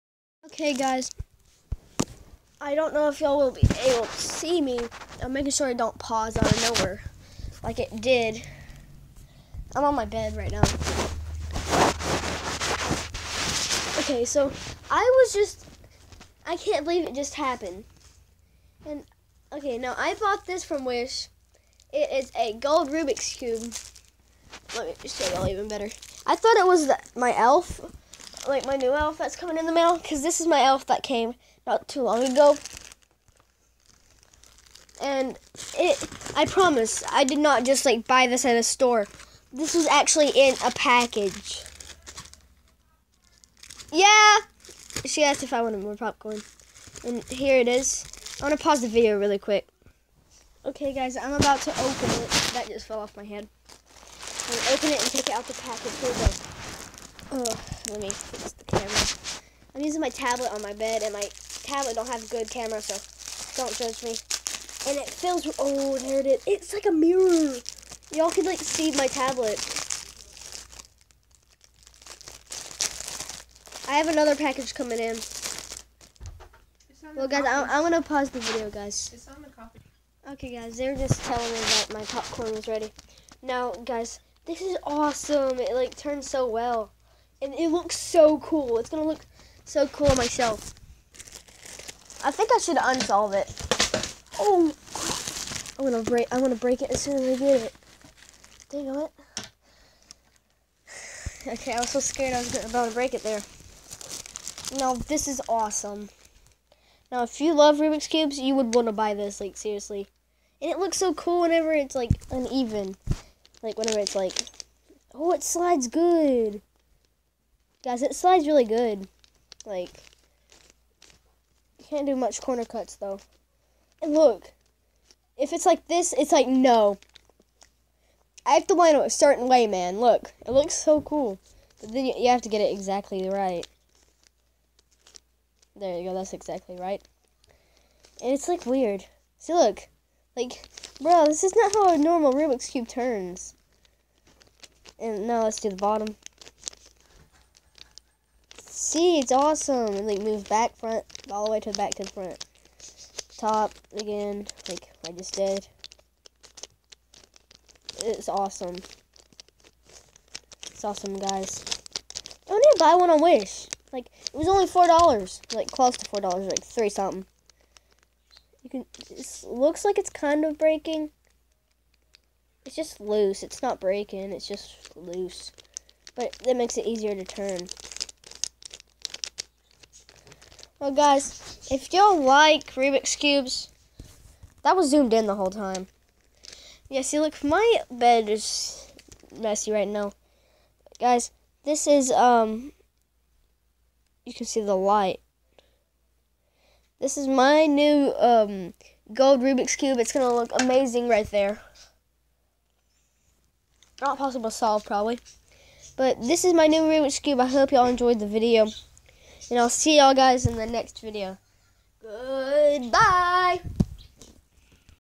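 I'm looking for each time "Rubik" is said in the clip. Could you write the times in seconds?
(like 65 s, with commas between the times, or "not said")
22 s, 107 s, 142 s, 182 s, 199 s, 206 s.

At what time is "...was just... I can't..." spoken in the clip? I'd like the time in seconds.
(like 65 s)
14 s.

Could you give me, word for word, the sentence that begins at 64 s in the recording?
And it fills, oh, there it is.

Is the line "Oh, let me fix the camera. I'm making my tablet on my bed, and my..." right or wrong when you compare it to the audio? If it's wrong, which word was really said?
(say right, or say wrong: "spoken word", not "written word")
wrong: "using", not "making".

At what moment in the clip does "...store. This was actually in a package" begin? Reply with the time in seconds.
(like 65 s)
38 s.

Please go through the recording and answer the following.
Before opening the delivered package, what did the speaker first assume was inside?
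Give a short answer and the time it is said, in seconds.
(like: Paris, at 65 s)
my new elf, at 28 s.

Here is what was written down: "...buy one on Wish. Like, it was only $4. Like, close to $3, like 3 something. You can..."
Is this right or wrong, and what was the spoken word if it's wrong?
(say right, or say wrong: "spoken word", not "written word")
wrong: "4", not "3".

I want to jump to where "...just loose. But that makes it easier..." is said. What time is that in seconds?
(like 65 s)
174 s.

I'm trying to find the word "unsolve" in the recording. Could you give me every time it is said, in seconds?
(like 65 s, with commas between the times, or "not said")
92 s.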